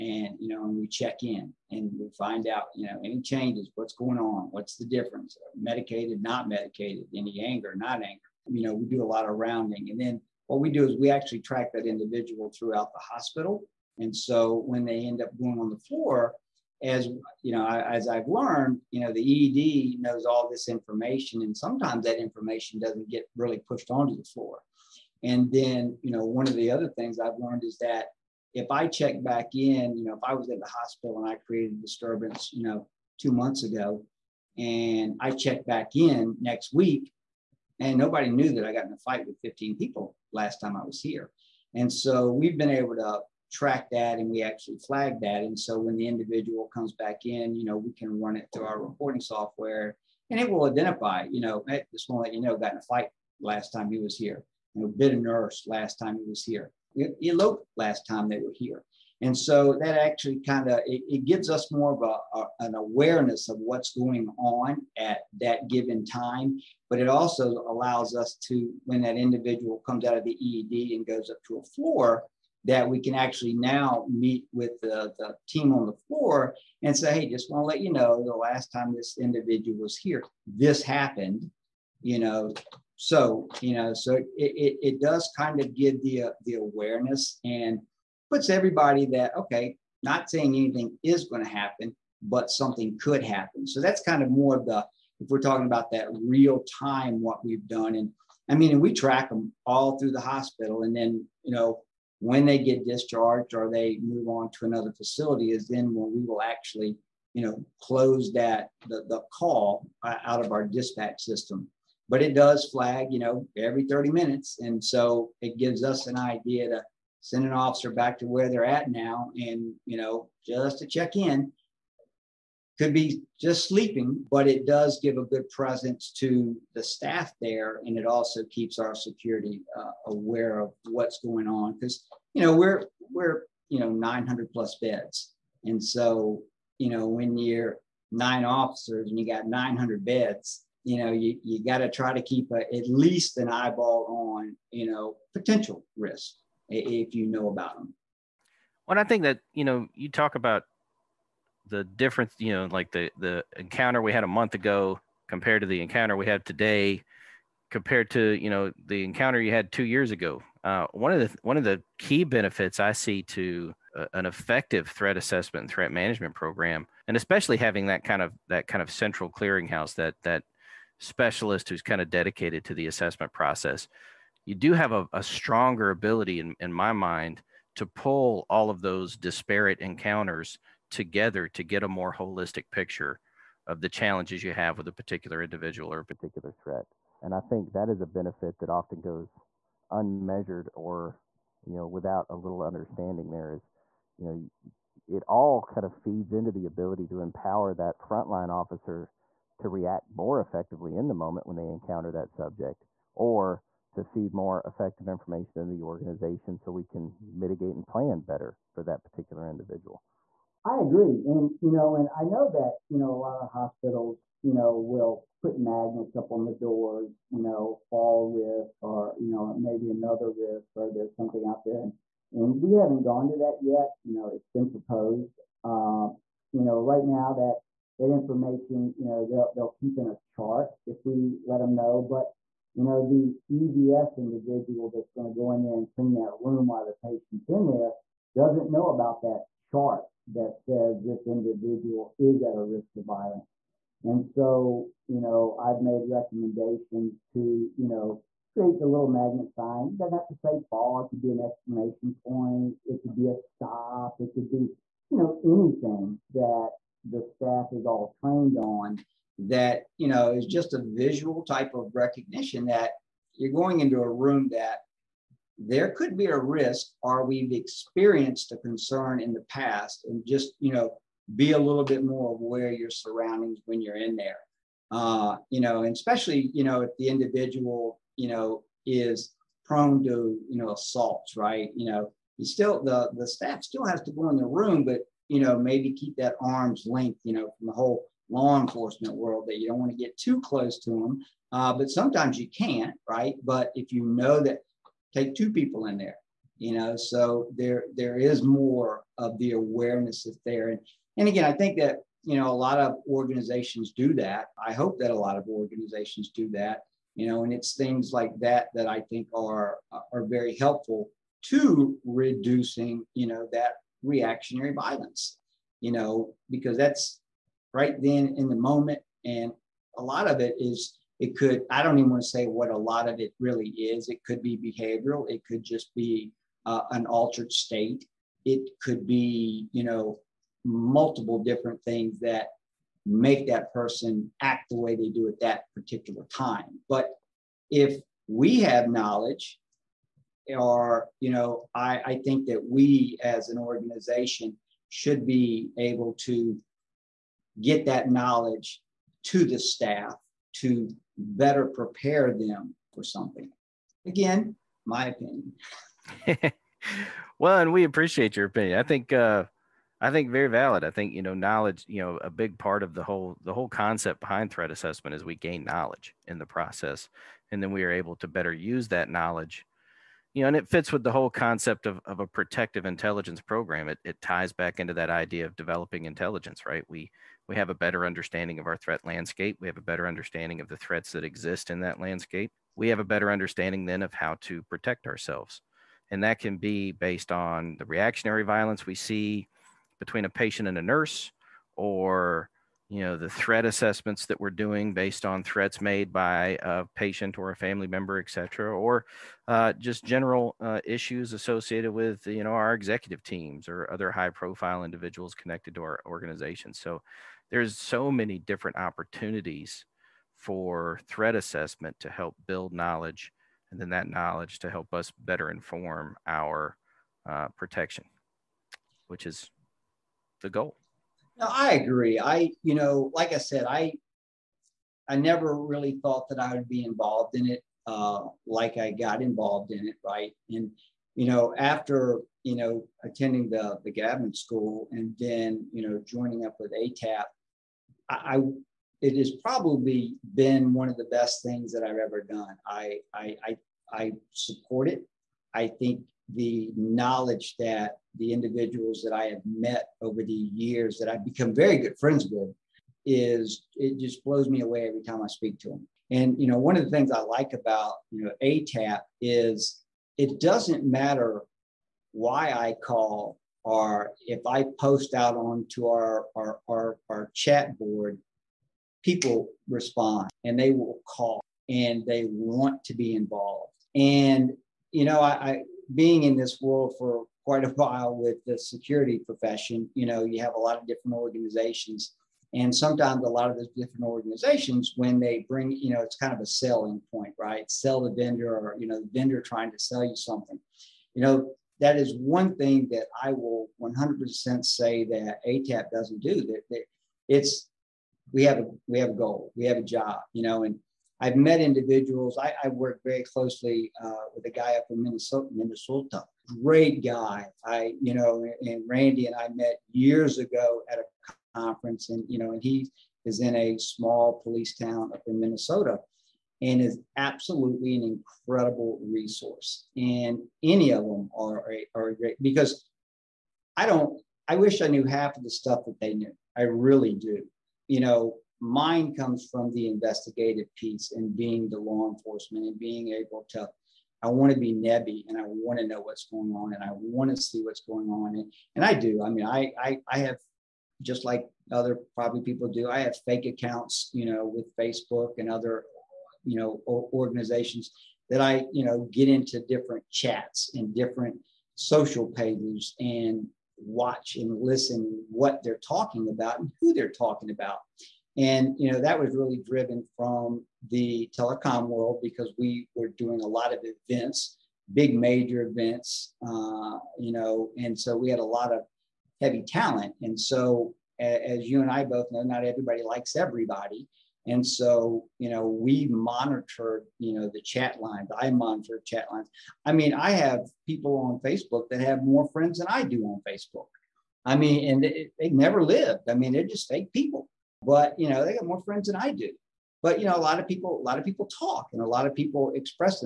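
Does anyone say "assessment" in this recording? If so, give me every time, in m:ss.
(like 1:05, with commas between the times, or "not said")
2:45, 2:52, 6:04, 6:33, 6:51.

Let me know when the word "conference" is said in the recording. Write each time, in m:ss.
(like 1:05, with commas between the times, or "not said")
8:31.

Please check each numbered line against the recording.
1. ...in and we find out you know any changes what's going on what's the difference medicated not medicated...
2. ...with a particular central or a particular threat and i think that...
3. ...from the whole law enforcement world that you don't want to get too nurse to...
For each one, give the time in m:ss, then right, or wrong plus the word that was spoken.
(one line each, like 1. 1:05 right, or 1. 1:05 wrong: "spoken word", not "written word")
1. 0:01 right
2. 3:04 wrong: "individual", not "central"
3. 4:47 wrong: "close", not "nurse".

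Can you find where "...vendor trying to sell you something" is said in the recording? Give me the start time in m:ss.
8:09.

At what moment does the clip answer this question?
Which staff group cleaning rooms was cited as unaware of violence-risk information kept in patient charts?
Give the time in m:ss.
3:53.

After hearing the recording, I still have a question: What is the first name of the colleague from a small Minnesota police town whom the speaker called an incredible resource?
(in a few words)
Randy.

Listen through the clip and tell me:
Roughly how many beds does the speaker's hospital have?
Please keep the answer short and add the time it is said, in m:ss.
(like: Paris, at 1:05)
900 plus, at 2:13.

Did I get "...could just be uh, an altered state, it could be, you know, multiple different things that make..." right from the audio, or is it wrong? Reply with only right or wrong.
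right.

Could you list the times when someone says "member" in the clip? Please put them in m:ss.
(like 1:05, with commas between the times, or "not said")
6:37.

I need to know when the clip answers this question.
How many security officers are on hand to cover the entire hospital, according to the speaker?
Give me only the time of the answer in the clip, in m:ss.
2:18.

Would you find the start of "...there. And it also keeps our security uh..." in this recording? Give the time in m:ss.
2:07.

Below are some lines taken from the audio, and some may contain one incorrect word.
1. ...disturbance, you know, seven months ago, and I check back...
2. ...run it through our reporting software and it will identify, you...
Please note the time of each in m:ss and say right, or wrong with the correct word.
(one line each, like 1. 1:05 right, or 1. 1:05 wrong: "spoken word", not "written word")
1. 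0:31 wrong: "two", not "seven"
2. 0:48 right.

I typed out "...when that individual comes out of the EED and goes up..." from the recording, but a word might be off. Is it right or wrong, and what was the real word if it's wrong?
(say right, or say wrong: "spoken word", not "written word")
right.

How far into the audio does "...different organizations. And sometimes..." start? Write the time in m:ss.
8:00.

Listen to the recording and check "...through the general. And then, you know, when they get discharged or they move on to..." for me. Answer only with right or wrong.
wrong.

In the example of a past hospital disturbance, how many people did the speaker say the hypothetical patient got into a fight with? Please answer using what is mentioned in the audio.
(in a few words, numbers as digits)
15.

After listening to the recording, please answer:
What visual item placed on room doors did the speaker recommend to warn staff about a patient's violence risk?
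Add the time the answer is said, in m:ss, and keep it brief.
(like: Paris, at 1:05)
magnet sign, at 4:09.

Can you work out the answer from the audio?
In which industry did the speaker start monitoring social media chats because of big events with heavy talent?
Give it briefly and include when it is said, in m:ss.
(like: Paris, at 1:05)
telecom, at 9:21.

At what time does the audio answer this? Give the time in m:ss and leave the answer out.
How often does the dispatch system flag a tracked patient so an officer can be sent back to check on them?
1:53.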